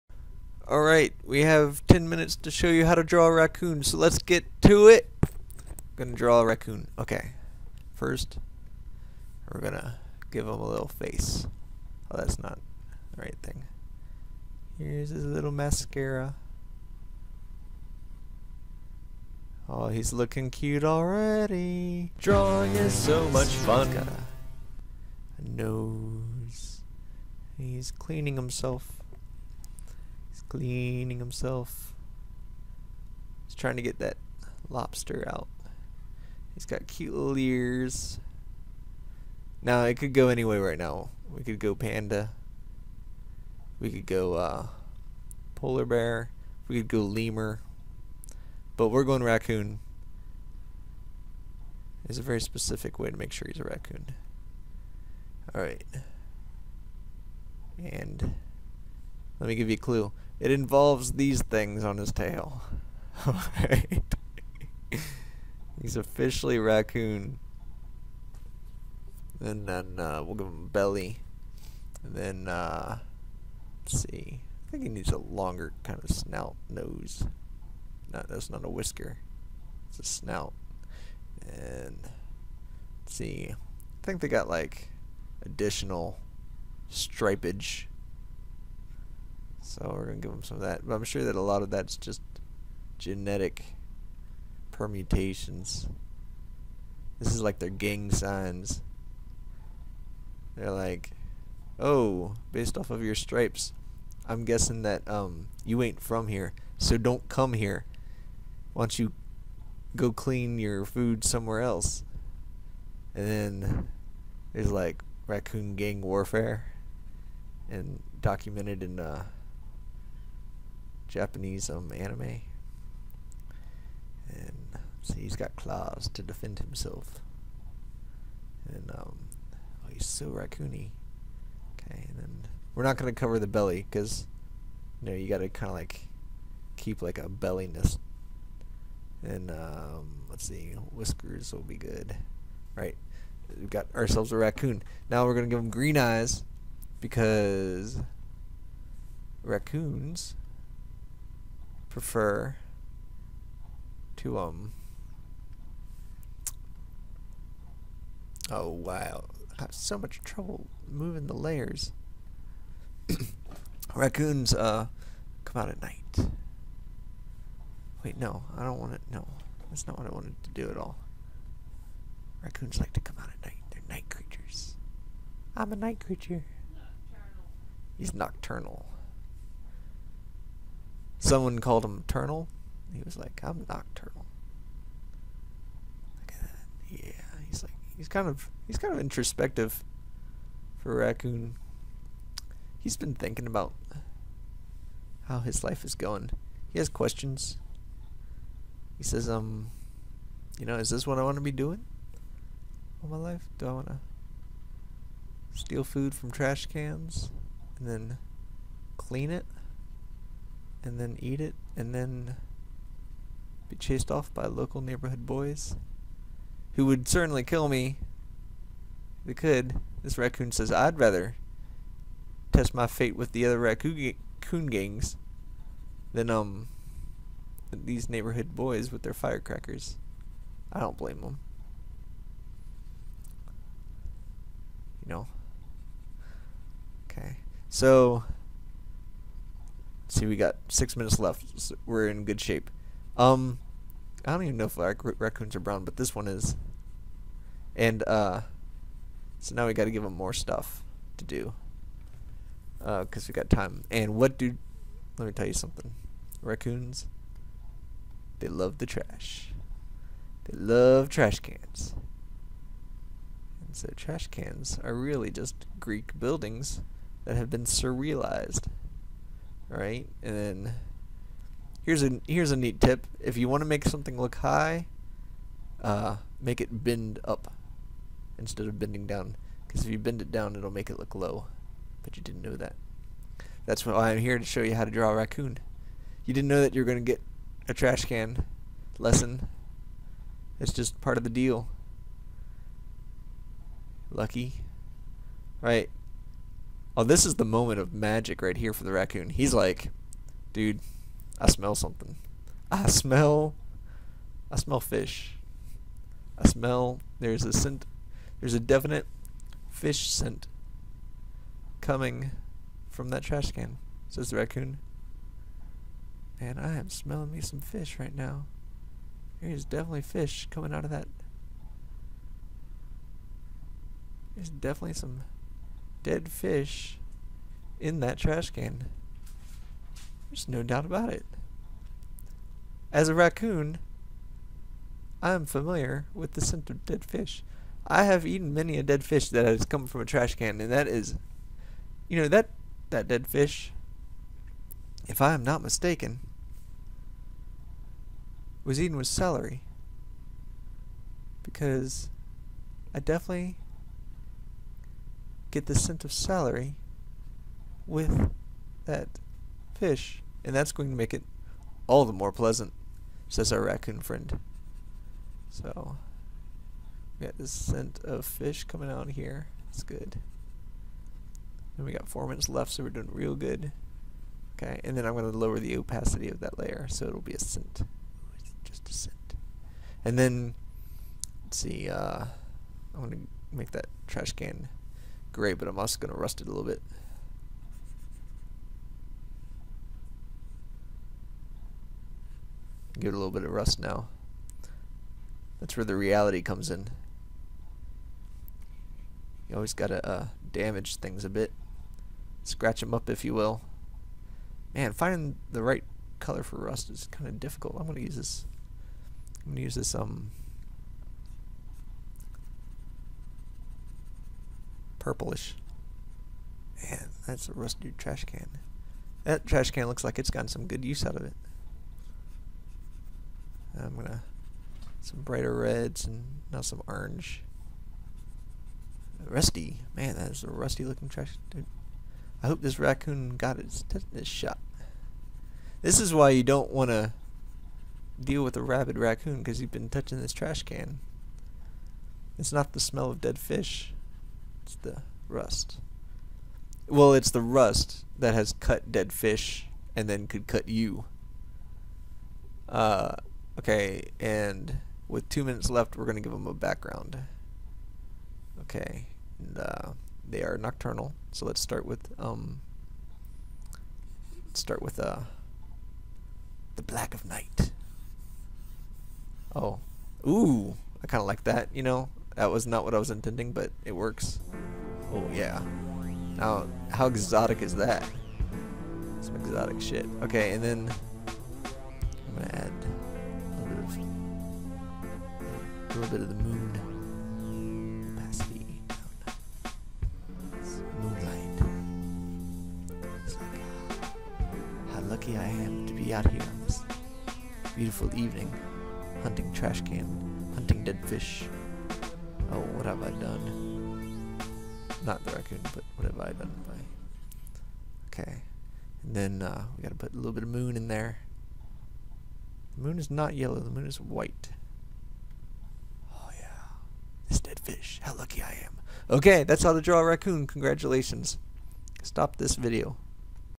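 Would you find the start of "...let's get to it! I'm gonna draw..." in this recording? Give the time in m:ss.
0:03.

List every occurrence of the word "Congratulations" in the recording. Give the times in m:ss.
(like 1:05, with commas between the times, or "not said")
8:40.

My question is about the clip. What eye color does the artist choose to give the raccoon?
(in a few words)
Green.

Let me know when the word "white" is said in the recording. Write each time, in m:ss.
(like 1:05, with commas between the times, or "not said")
8:34.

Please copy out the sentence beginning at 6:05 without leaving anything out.
So, we got the scent of fish coming out here.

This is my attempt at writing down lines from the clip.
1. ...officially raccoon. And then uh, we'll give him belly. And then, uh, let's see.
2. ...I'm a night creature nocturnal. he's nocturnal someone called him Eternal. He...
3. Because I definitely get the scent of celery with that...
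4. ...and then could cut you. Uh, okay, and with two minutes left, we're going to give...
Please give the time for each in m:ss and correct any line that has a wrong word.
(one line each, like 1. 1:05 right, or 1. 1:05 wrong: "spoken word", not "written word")
1. 1:05 right
2. 2:55 right
3. 5:51 right
4. 7:29 right.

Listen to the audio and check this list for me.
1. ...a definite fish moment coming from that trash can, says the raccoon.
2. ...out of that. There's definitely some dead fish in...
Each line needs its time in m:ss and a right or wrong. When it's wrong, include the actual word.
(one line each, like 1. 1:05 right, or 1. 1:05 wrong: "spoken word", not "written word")
1. 5:08 wrong: "scent", not "moment"
2. 5:20 right.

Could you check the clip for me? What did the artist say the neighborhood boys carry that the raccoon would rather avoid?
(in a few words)
Firecrackers.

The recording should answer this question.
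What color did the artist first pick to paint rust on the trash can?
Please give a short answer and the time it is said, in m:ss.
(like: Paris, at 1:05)
Purplish, at 6:55.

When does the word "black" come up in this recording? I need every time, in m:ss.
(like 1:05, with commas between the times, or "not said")
7:46.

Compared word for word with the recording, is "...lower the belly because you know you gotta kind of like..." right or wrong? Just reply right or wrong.
wrong.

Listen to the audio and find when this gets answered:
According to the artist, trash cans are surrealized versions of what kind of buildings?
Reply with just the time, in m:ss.
4:25.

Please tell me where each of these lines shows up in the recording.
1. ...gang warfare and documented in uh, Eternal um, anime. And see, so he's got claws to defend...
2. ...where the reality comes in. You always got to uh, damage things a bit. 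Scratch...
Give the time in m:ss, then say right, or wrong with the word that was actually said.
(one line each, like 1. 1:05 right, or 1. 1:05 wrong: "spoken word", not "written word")
1. 1:55 wrong: "Japanese", not "Eternal"
2. 6:35 right.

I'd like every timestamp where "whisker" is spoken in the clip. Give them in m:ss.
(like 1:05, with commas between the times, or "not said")
1:18, 2:20.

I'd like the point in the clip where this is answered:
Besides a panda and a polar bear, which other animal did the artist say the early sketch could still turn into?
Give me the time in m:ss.
0:46.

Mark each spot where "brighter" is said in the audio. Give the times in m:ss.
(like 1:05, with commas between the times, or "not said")
7:05.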